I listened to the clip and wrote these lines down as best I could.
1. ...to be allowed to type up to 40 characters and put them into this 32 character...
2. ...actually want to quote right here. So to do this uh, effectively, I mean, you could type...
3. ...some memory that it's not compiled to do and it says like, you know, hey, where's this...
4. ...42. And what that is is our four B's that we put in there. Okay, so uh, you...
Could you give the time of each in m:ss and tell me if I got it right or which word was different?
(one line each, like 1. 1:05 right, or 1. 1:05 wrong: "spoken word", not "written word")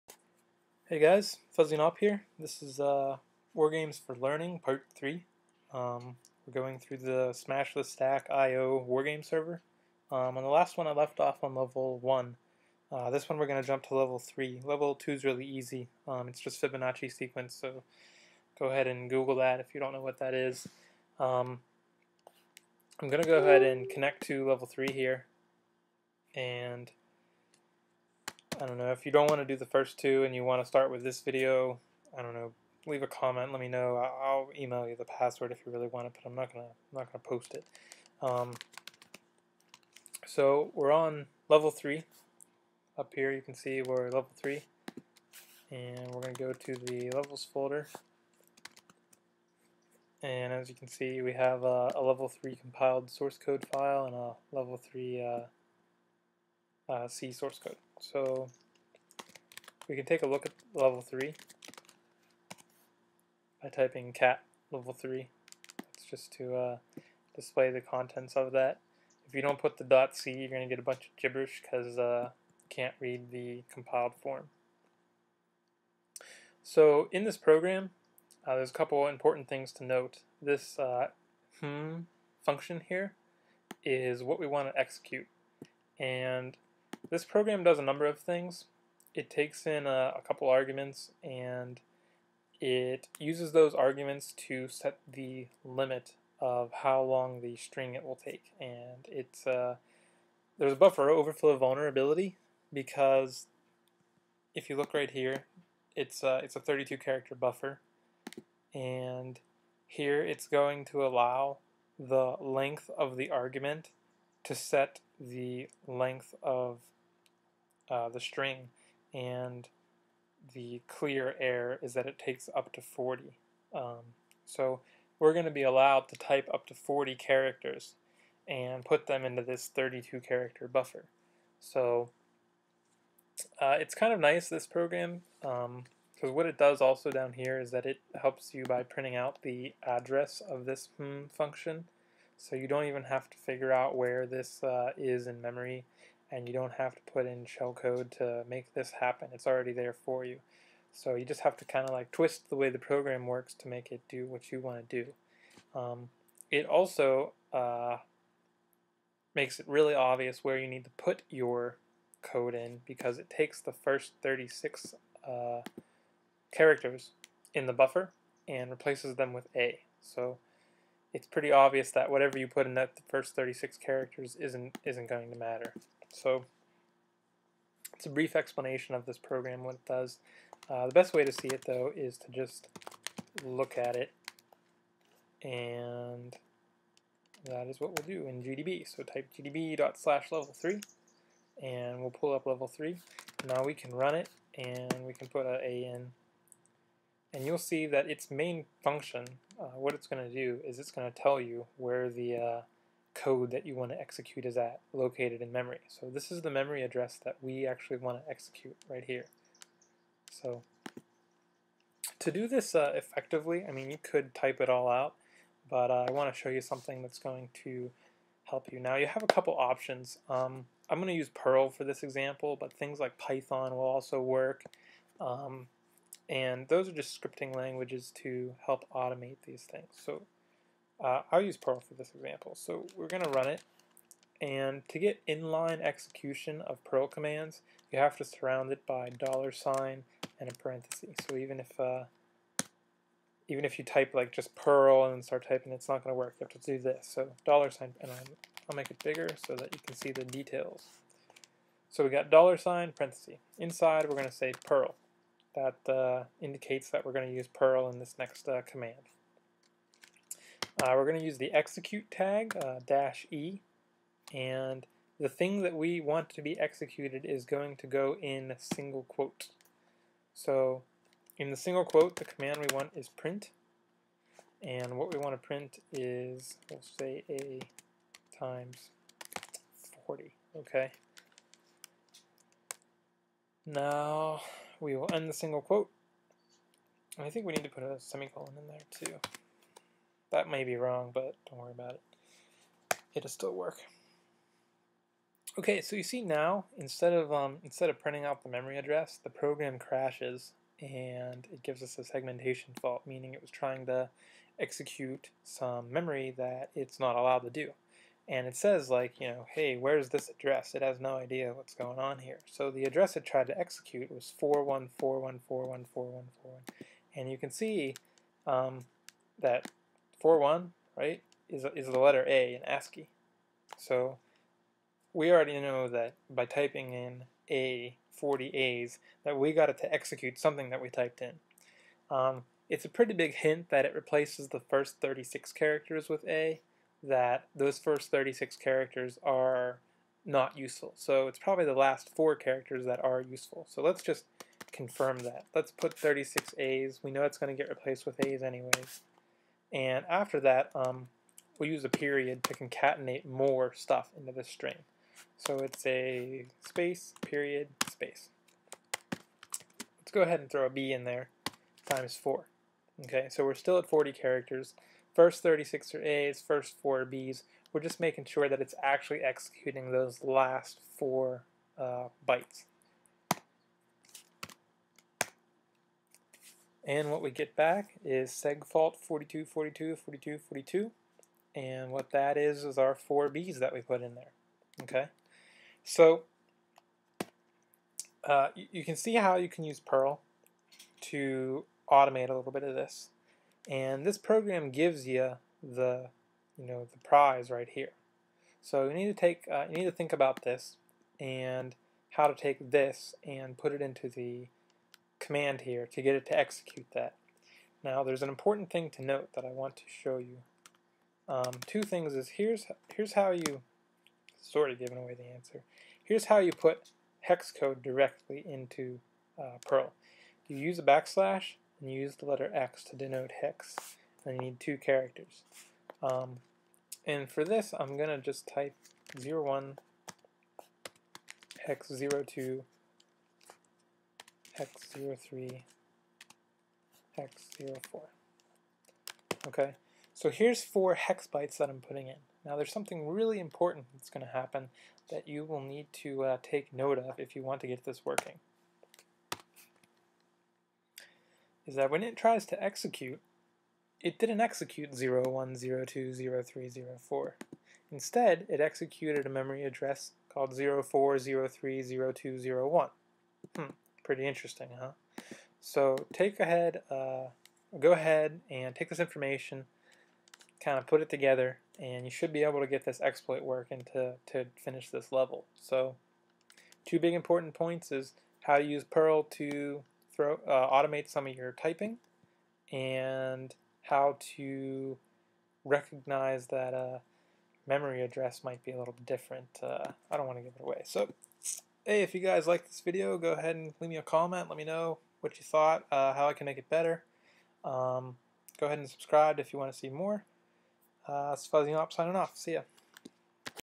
1. 2:05 right
2. 3:27 wrong: "execute", not "quote"
3. 5:05 wrong: "allowed", not "compiled"
4. 6:20 right.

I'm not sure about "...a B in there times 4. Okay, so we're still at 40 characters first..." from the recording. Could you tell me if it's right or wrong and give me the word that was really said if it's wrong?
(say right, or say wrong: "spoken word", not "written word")
right.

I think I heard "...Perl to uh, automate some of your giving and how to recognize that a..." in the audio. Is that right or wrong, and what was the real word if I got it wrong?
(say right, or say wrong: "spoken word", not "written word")
wrong: "typing", not "giving".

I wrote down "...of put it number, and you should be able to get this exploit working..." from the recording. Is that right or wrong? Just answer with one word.
wrong.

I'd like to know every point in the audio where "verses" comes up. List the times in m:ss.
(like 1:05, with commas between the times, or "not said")
not said.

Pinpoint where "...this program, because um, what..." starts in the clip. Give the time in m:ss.
2:14.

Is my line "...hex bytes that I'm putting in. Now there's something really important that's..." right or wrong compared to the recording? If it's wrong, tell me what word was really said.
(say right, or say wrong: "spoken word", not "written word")
right.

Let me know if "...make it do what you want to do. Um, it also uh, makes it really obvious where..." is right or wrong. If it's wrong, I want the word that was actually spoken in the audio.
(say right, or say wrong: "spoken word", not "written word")
right.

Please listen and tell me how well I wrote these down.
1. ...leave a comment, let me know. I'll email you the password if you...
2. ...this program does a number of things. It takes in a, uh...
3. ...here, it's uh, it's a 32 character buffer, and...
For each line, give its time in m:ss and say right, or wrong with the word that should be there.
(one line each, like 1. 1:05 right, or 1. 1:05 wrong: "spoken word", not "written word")
1. 0:32 right
2. 1:27 right
3. 1:45 right.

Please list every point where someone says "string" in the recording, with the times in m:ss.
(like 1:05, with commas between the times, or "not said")
1:37, 1:58, 5:54.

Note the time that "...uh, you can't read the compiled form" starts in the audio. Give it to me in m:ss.
1:11.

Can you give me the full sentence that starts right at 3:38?
Now you have a couple options.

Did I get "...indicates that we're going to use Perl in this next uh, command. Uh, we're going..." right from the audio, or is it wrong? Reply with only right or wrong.
right.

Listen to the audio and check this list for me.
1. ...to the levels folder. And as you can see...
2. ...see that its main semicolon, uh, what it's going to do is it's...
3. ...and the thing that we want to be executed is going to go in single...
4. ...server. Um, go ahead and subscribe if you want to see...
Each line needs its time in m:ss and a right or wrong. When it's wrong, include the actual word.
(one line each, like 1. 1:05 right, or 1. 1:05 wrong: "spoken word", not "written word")
1. 0:46 right
2. 3:17 wrong: "function", not "semicolon"
3. 4:24 right
4. 8:16 wrong: "better", not "server".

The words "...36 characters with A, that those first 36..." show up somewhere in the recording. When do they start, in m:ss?
5:35.